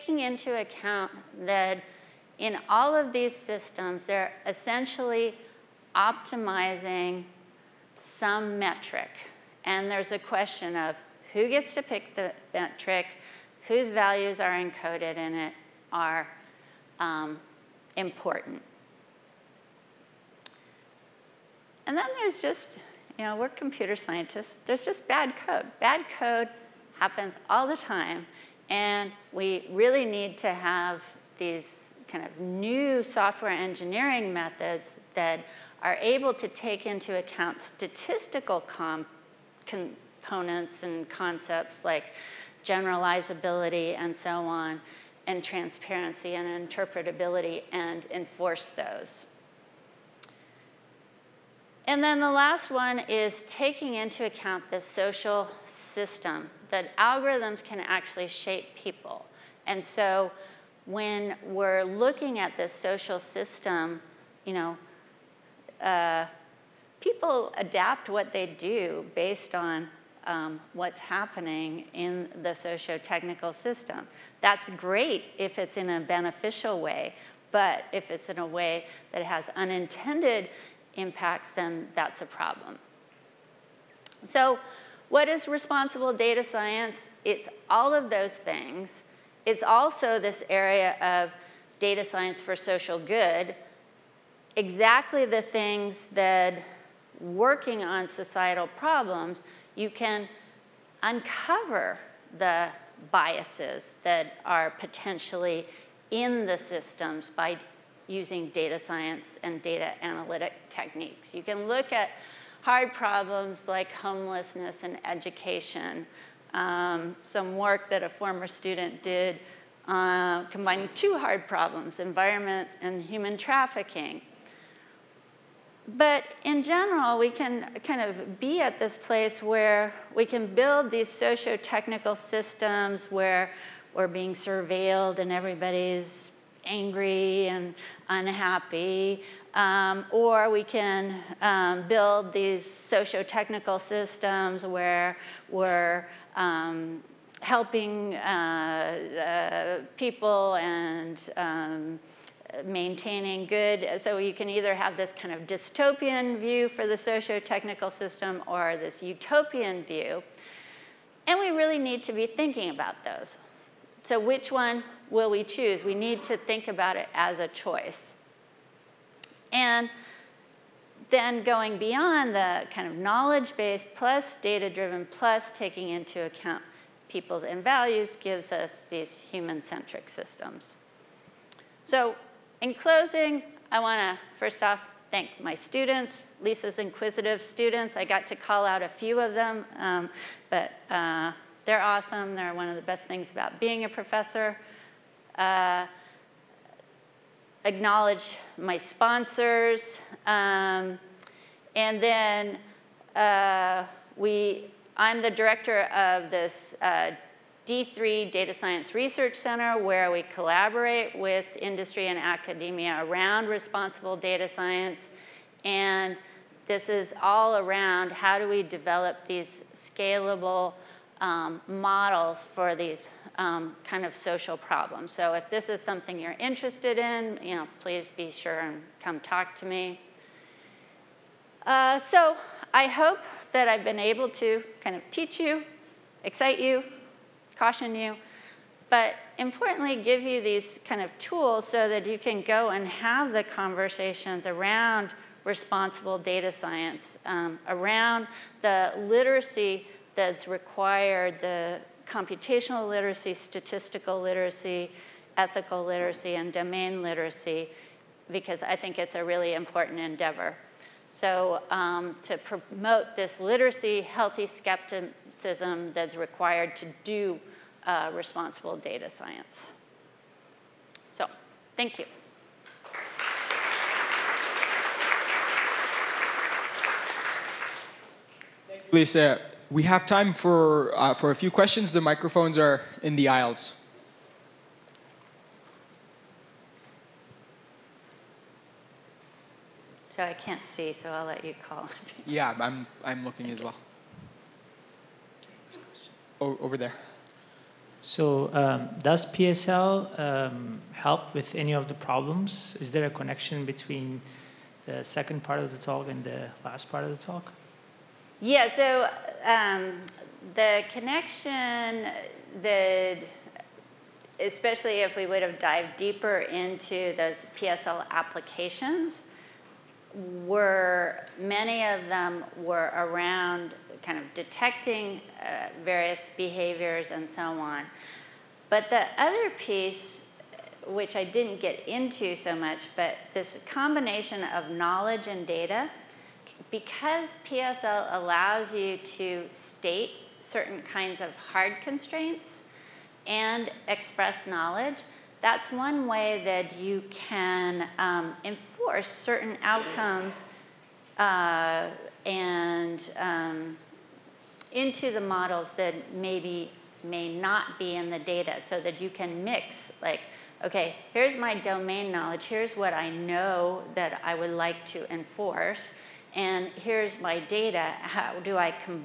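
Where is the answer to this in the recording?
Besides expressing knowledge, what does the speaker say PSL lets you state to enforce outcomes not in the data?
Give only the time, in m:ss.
5:41.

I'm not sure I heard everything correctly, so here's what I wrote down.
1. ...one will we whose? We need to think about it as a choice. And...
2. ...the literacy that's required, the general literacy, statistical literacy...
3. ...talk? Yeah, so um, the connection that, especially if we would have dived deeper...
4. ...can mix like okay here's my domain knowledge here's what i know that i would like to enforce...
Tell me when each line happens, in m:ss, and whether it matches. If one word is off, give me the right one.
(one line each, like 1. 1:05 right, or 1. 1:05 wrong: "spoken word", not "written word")
1. 2:44 wrong: "choose", not "whose"
2. 4:08 wrong: "computational", not "general"
3. 5:07 right
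4. 5:59 right.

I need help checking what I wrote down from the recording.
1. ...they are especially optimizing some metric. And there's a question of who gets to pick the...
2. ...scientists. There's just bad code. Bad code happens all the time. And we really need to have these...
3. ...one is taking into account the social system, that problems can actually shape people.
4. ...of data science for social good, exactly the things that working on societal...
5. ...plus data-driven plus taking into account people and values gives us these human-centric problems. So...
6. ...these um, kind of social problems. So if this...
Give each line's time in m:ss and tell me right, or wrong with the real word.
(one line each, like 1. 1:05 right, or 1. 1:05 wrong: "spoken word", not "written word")
1. 0:04 wrong: "essentially", not "especially"
2. 0:23 right
3. 0:52 wrong: "algorithms", not "problems"
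4. 1:31 right
5. 2:53 wrong: "systems", not "problems"
6. 3:42 right.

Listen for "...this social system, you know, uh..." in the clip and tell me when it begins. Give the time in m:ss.
1:02.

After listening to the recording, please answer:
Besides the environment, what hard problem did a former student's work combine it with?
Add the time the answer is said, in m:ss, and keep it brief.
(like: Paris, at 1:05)
human trafficking, at 2:03.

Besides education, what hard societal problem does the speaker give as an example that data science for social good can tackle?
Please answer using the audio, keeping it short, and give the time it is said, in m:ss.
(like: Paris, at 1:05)
homelessness, at 1:53.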